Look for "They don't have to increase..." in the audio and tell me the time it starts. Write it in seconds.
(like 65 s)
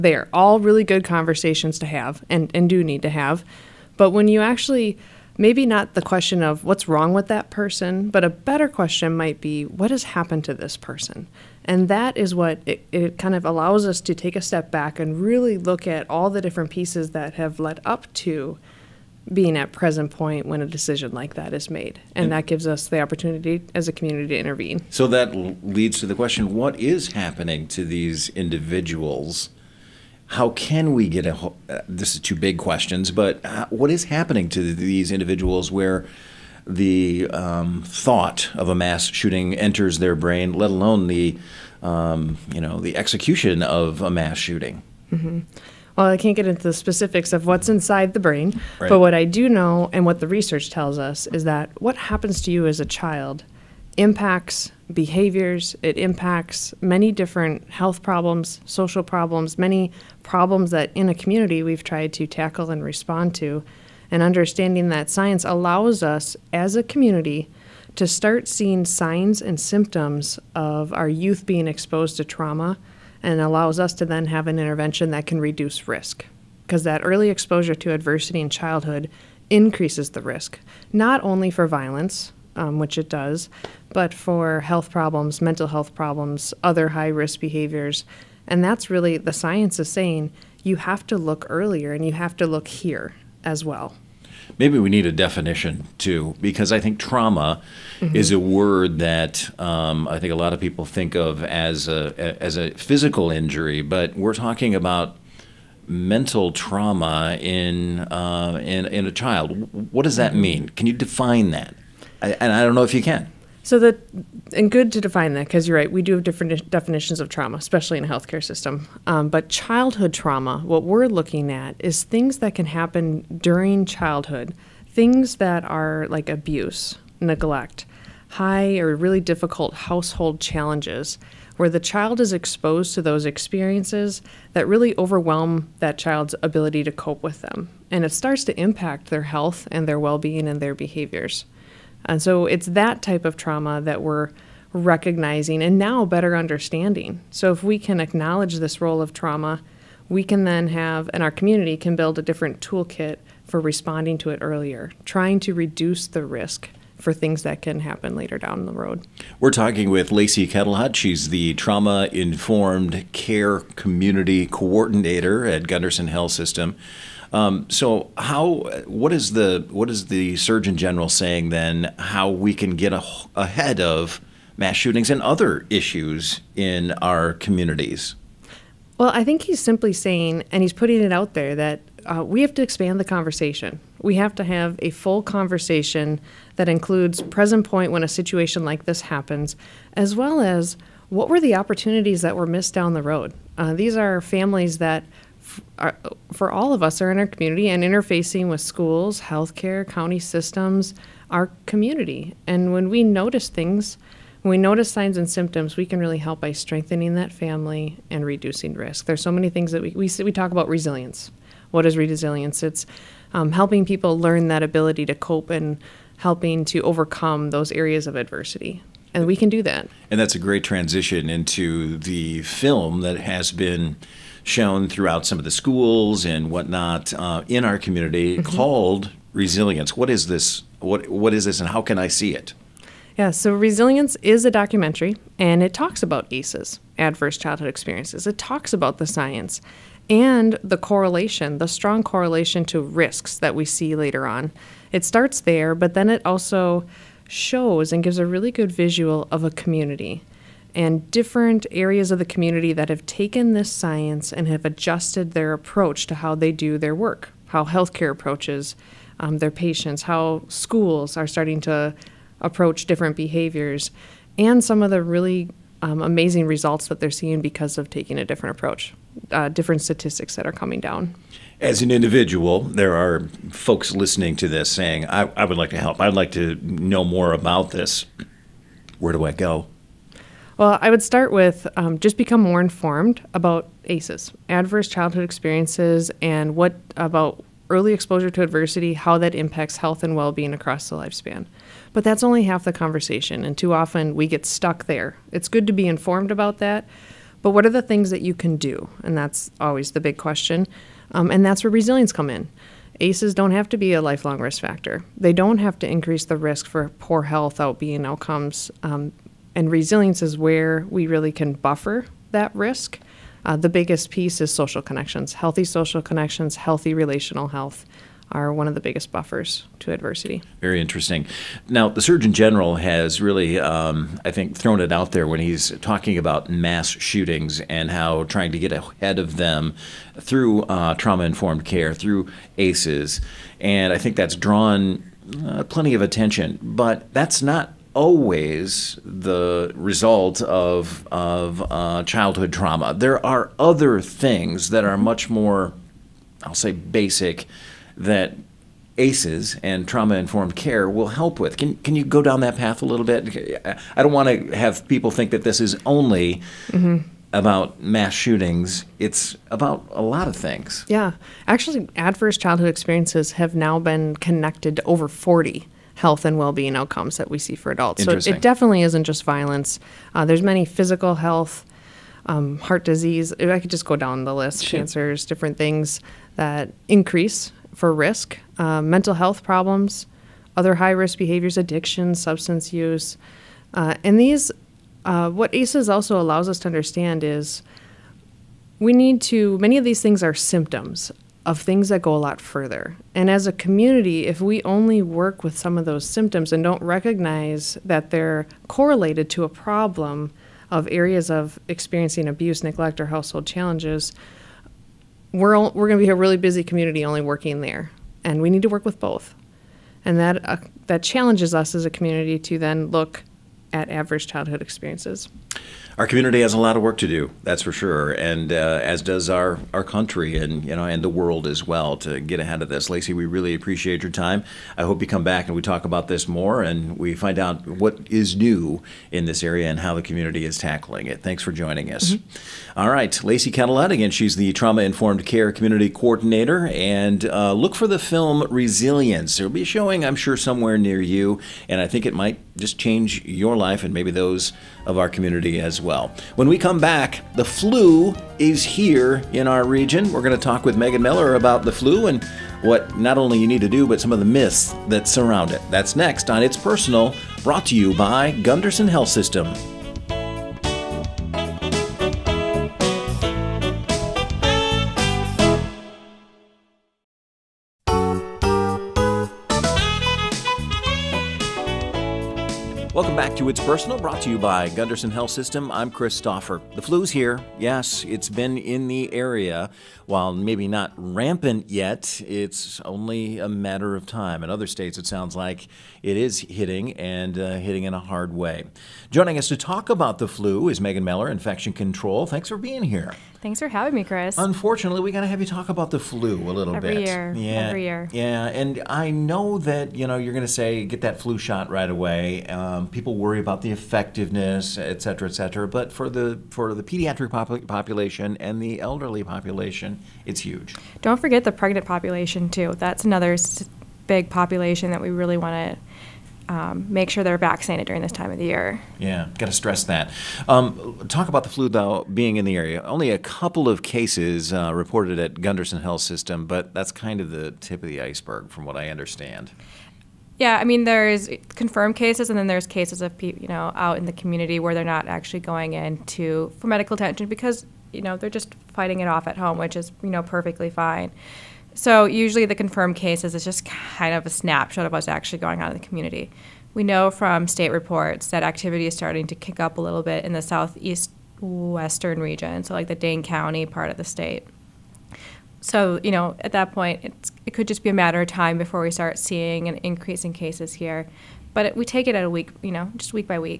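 305 s.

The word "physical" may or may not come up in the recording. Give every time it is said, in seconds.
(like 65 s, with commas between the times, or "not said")
102 s, 370 s.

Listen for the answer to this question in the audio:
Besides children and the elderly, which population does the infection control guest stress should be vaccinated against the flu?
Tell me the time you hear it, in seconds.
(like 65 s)
511 s.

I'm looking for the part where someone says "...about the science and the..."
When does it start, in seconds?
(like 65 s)
238 s.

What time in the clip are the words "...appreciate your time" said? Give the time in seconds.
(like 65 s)
423 s.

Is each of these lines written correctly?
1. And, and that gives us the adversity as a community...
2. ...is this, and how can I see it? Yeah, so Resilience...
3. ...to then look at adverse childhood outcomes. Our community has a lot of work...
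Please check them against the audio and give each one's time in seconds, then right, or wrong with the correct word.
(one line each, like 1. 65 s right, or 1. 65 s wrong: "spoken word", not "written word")
1. 22 s wrong: "opportunity", not "adversity"
2. 231 s right
3. 412 s wrong: "experiences", not "outcomes".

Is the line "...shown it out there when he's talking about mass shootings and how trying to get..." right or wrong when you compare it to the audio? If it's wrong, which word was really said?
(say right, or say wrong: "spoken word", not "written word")
wrong: "thrown", not "shown".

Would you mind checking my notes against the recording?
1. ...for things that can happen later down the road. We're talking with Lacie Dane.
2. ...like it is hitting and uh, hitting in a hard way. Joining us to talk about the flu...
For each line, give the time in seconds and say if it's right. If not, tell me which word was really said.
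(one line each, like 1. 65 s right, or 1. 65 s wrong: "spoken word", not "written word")
1. 156 s wrong: "Ketelhut", not "Dane"
2. 485 s right.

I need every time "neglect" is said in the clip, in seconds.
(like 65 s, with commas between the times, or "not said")
127 s, 402 s.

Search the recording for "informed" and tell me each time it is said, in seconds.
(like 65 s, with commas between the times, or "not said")
162 s, 282 s, 295 s, 331 s, 350 s, 434 s.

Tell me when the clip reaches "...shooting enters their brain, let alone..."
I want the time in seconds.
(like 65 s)
39 s.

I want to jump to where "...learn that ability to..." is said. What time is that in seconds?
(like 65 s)
214 s.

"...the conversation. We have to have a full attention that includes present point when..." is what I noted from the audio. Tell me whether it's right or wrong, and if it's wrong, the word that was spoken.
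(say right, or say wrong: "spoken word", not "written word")
wrong: "conversation", not "attention".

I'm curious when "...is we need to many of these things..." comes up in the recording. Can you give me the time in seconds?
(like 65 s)
387 s.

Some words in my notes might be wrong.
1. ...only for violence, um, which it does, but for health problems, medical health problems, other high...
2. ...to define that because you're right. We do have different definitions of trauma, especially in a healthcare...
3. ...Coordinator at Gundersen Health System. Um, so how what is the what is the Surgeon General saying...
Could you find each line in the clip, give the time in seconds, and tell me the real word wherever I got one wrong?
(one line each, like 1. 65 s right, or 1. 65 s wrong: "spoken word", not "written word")
1. 81 s wrong: "mental", not "medical"
2. 114 s right
3. 164 s right.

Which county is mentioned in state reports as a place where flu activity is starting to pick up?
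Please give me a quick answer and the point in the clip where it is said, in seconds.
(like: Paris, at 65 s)
Dane County, at 552 s.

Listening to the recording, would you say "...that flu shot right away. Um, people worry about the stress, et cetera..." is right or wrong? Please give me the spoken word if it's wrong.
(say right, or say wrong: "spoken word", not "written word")
wrong: "effectiveness", not "stress".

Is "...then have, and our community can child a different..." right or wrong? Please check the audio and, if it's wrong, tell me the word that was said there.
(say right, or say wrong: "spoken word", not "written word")
wrong: "build", not "child".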